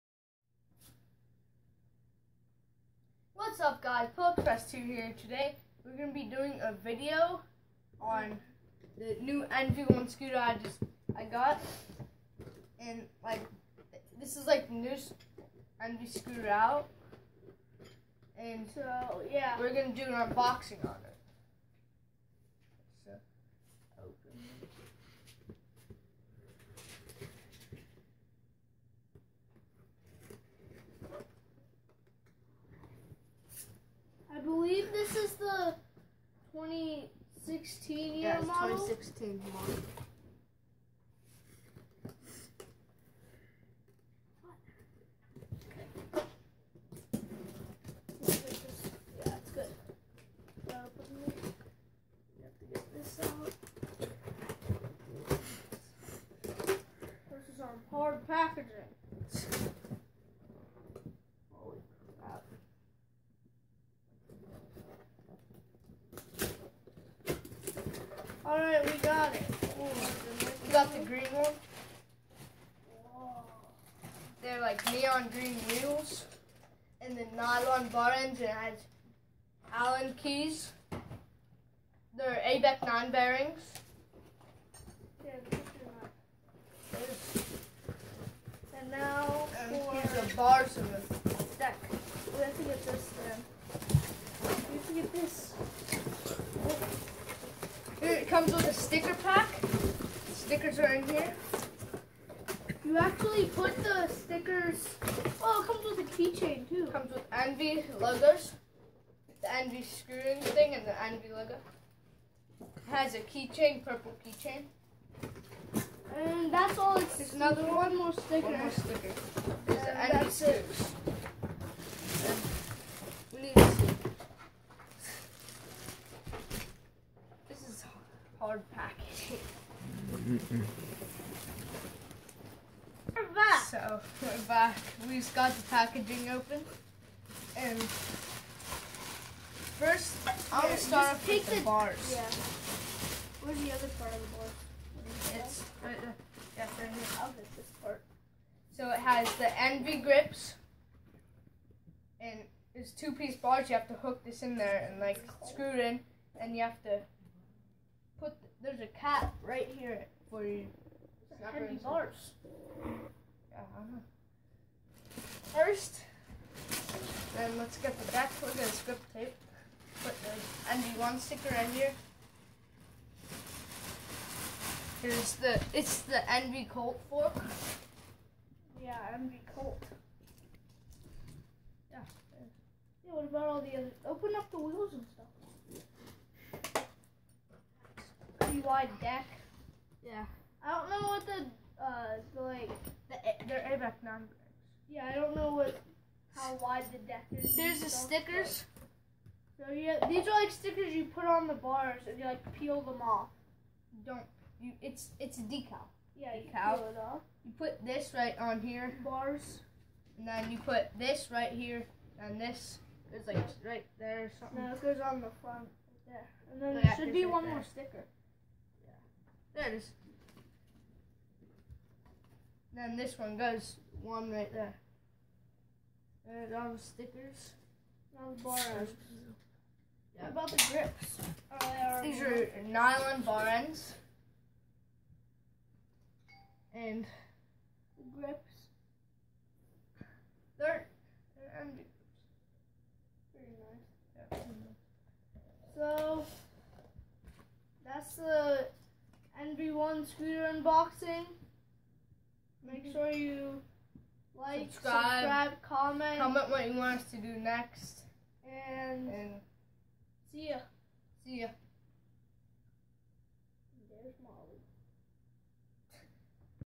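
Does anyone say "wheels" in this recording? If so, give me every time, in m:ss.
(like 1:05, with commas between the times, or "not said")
1:15, 3:04.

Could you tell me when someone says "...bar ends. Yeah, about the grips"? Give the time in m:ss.
3:48.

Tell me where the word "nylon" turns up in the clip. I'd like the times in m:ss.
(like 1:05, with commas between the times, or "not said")
1:17, 3:52.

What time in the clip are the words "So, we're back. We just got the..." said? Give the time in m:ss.
2:13.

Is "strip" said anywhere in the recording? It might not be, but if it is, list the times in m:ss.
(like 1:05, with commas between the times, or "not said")
2:48.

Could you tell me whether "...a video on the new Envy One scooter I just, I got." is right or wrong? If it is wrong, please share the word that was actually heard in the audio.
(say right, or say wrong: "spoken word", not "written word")
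right.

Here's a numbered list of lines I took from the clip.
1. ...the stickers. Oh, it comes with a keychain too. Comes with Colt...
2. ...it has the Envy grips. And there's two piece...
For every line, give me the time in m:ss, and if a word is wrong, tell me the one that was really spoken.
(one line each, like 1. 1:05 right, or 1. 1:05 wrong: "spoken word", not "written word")
1. 1:43 wrong: "Envy", not "Colt"
2. 2:28 right.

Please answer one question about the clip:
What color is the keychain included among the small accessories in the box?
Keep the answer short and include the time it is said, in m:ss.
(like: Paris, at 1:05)
Purple, at 1:53.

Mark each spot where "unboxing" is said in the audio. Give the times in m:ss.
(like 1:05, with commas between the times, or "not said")
0:20, 4:10.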